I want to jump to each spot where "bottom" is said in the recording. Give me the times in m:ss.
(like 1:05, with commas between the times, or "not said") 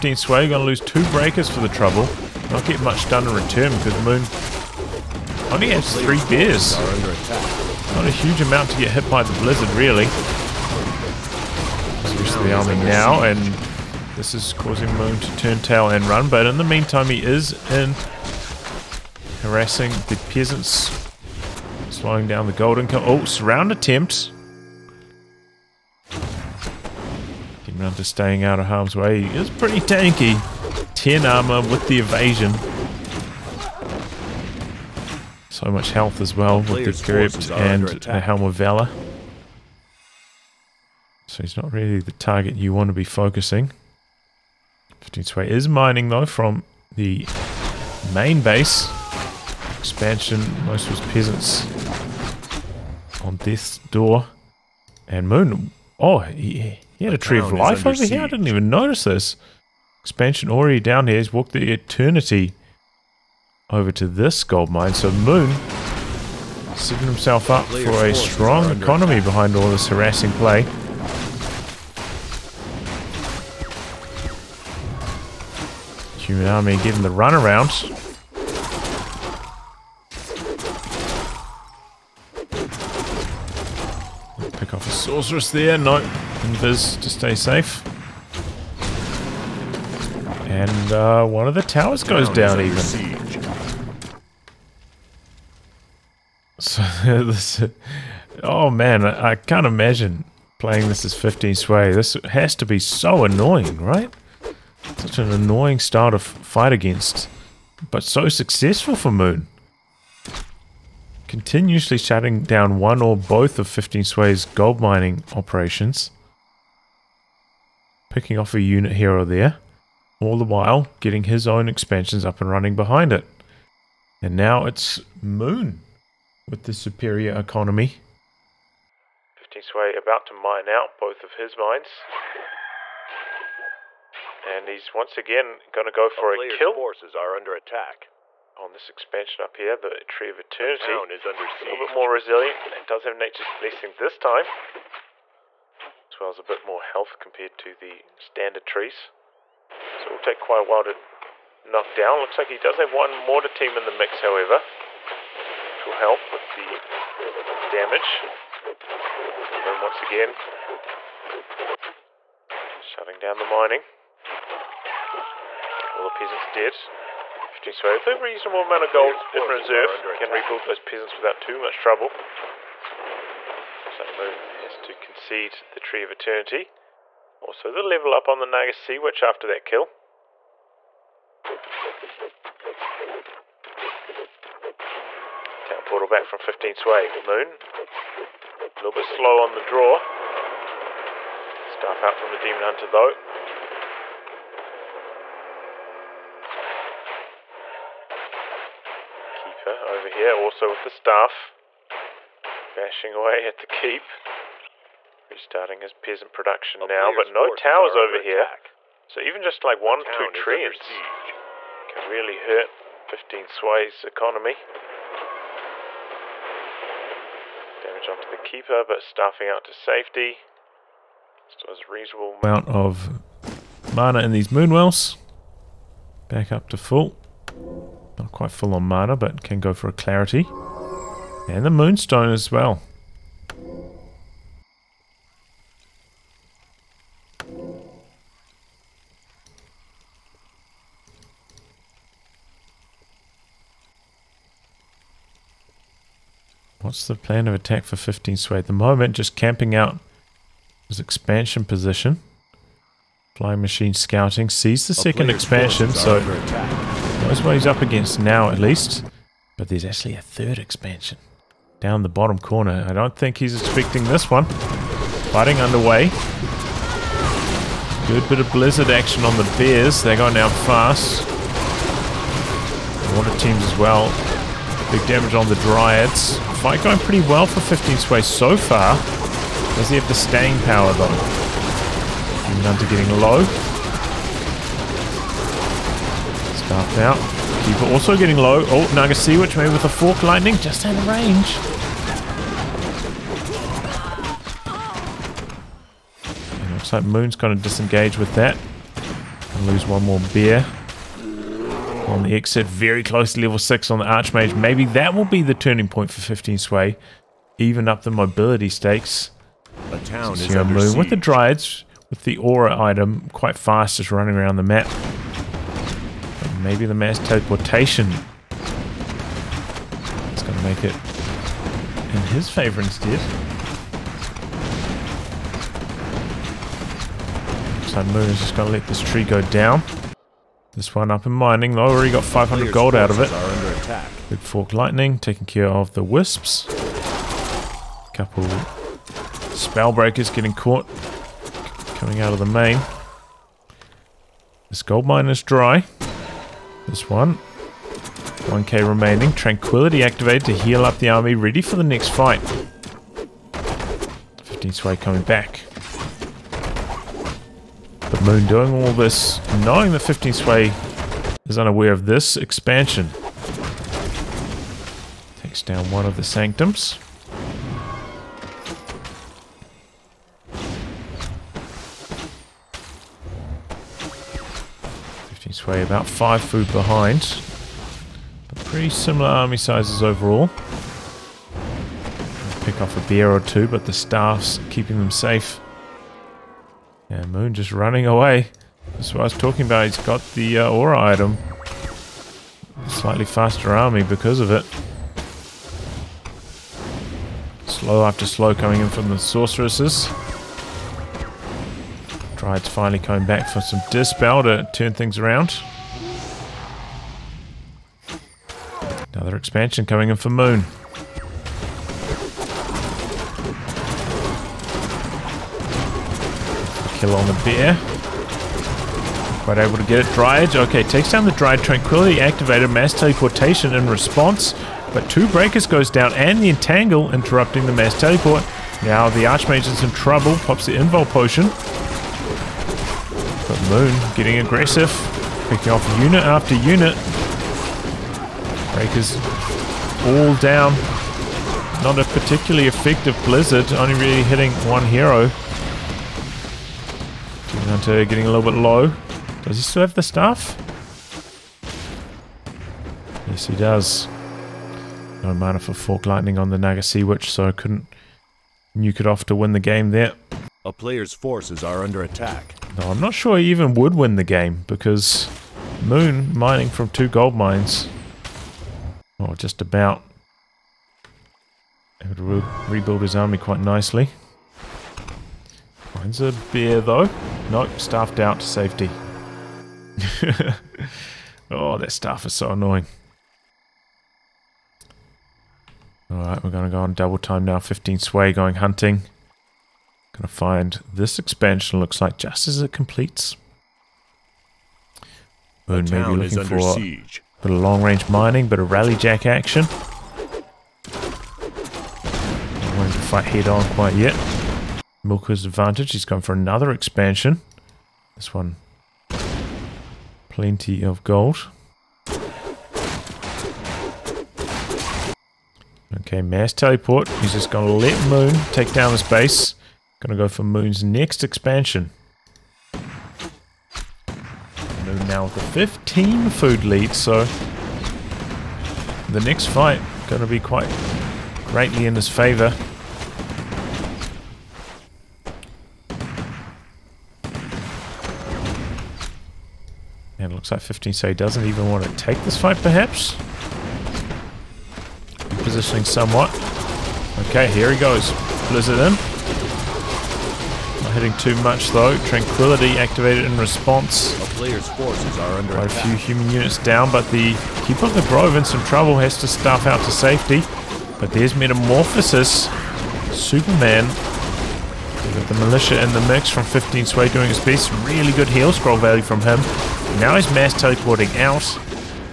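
4:22.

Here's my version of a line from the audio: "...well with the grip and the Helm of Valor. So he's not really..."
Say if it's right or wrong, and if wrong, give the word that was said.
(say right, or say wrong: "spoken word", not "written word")
right.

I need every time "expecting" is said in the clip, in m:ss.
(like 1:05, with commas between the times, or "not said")
4:23.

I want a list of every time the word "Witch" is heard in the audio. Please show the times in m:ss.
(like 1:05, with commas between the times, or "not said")
2:58, 4:49, 7:37.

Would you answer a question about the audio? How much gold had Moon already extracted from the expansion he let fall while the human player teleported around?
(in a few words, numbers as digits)
500 gold.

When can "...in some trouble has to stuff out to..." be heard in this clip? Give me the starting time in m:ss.
9:18.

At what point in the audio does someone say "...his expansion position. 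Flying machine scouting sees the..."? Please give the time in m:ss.
4:10.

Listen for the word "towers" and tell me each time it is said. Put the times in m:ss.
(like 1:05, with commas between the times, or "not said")
1:31, 3:27.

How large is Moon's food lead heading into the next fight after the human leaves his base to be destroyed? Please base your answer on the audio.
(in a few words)
15 food.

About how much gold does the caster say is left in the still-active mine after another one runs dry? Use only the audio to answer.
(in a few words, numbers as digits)
1k.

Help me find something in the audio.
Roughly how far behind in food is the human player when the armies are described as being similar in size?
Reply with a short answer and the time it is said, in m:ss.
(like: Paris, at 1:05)
five food, at 6:16.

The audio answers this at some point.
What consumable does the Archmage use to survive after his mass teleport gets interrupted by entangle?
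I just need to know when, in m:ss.
7:10.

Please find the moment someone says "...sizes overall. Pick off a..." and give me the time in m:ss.
6:19.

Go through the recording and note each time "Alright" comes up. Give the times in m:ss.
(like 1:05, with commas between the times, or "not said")
8:06.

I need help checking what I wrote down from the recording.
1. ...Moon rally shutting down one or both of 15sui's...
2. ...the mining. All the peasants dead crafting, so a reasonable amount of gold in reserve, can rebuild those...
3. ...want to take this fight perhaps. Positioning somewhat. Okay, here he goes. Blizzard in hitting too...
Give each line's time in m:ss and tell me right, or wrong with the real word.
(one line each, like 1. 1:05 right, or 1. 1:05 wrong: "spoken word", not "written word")
1. 1:49 wrong: "continuously", not "rally"
2. 2:43 right
3. 9:01 right.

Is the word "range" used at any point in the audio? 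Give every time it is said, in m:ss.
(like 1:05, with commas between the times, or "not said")
4:51, 8:17.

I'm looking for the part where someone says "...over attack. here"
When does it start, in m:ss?
3:27.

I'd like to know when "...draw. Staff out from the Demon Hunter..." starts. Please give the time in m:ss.
3:09.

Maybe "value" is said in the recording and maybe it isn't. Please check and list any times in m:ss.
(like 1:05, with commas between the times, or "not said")
9:28.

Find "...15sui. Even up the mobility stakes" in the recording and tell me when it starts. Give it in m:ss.
5:06.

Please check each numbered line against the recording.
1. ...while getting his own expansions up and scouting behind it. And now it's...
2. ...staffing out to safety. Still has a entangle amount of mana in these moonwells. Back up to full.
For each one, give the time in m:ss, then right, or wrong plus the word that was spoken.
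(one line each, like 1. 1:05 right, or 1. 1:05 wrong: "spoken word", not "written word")
1. 2:00 wrong: "running", not "scouting"
2. 3:39 wrong: "reasonable", not "entangle".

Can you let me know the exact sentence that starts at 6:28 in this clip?
That's what I was talking about.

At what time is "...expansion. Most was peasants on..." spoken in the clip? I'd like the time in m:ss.
0:49.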